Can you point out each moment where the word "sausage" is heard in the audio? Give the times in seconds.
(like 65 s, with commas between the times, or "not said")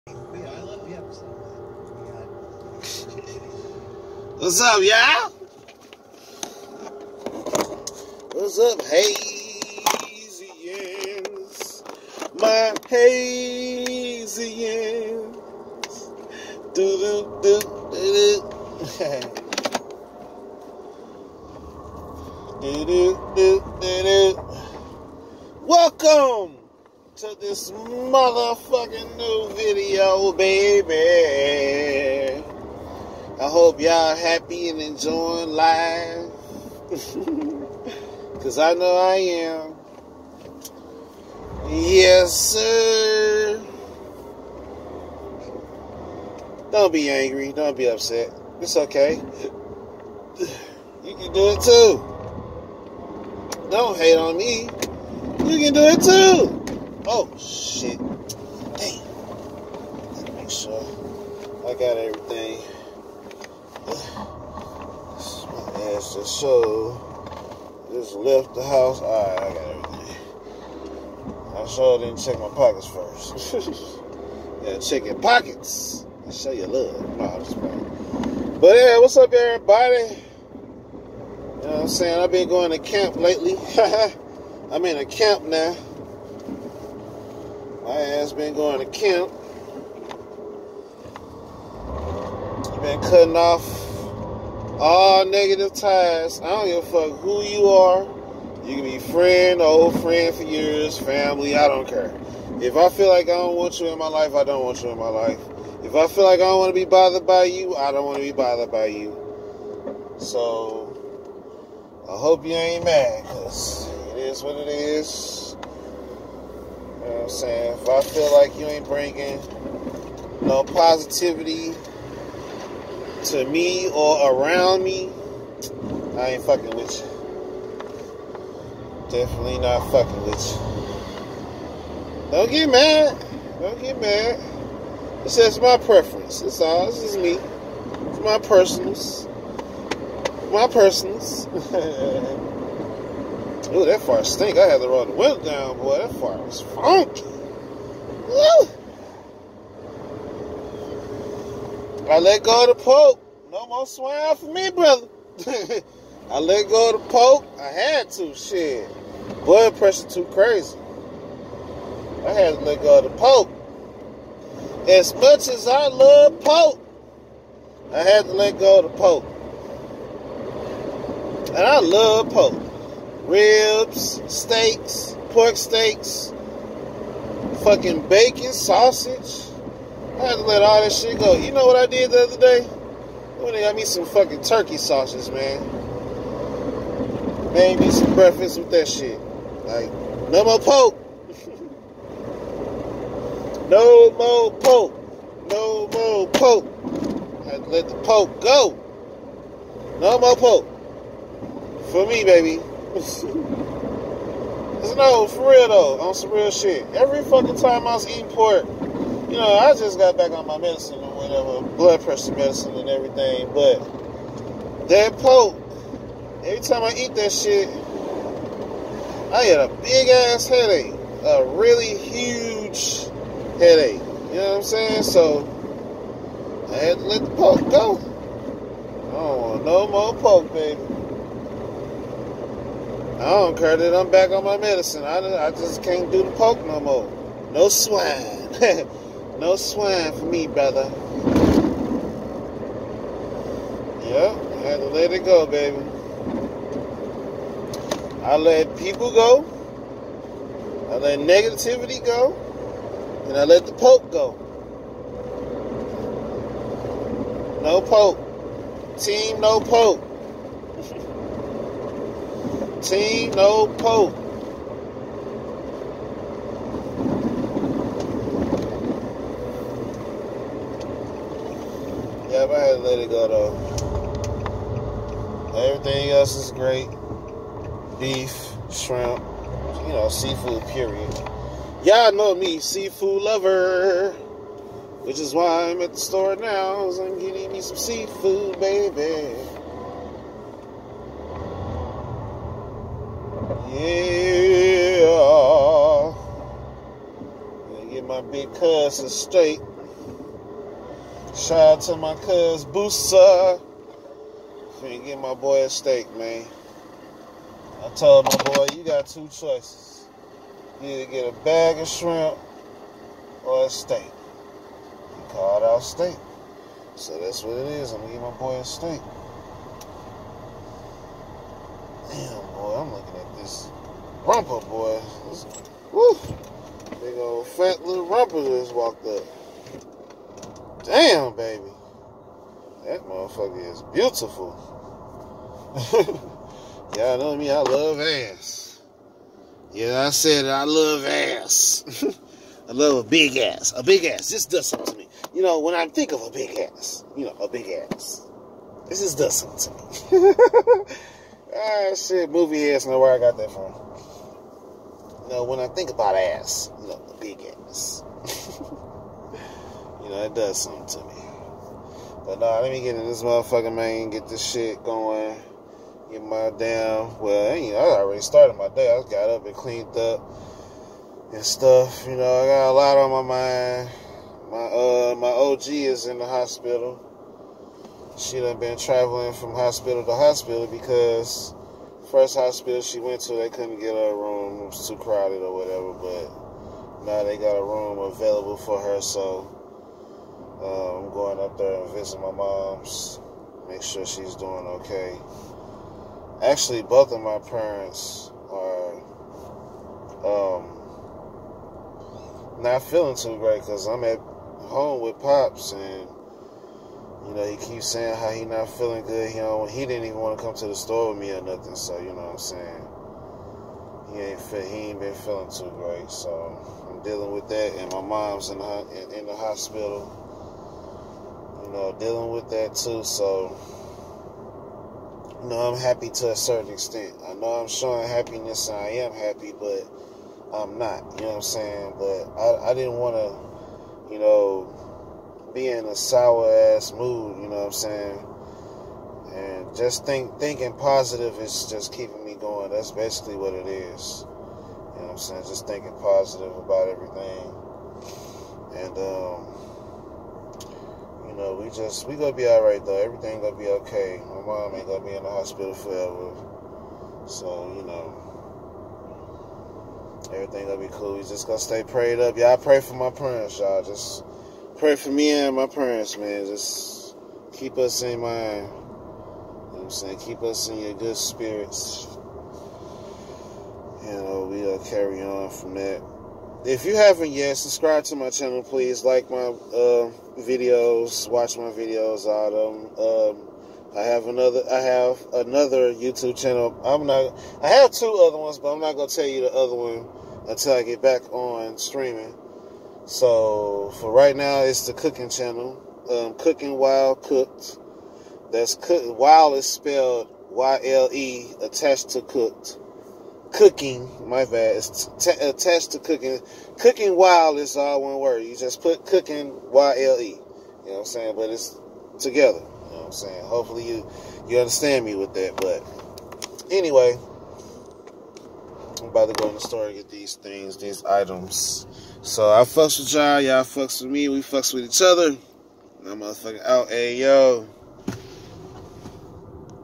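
178 s, 184 s.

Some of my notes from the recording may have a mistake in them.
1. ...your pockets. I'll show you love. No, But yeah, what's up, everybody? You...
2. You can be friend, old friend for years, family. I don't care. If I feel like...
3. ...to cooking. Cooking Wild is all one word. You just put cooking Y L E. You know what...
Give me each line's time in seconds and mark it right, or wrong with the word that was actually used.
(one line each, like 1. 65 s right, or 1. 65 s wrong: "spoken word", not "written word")
1. 75 s right
2. 98 s right
3. 505 s right.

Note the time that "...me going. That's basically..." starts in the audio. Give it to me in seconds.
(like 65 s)
442 s.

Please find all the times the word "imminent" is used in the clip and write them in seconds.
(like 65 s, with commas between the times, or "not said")
not said.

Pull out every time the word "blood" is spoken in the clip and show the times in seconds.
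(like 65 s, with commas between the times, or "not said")
159 s, 211 s.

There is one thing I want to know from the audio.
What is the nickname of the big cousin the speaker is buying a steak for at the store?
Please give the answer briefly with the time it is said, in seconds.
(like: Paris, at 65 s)
Boosa, at 302 s.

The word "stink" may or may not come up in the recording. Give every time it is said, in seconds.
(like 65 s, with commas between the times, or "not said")
144 s.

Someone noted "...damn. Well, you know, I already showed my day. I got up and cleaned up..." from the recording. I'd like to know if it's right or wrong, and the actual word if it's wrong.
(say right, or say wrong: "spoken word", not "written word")
wrong: "started", not "showed".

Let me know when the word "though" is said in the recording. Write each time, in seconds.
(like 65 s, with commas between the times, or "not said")
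205 s, 273 s, 452 s.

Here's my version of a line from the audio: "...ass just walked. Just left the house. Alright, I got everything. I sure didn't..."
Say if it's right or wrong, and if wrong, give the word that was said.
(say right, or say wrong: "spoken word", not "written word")
wrong: "showed", not "walked".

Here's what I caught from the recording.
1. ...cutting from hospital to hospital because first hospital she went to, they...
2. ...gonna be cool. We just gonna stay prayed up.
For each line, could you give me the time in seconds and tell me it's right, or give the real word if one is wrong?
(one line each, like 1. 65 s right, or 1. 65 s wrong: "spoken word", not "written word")
1. 378 s wrong: "traveling", not "cutting"
2. 460 s right.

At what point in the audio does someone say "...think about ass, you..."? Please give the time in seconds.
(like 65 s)
355 s.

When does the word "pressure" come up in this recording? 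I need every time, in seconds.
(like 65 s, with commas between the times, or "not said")
159 s, 212 s.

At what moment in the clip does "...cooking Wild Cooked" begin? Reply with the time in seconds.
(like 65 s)
496 s.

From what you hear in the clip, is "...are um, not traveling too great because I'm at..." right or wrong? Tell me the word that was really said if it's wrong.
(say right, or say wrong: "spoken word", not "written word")
wrong: "feeling", not "traveling".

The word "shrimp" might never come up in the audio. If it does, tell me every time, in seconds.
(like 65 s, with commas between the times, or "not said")
278 s, 311 s.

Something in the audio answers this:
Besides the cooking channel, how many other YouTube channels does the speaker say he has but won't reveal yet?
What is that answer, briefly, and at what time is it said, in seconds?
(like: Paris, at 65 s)
2, at 487 s.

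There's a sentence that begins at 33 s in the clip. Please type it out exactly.
I hope y'all happy and enjoying life.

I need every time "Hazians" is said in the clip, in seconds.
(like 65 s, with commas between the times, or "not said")
8 s, 12 s.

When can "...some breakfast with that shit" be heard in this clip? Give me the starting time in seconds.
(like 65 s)
187 s.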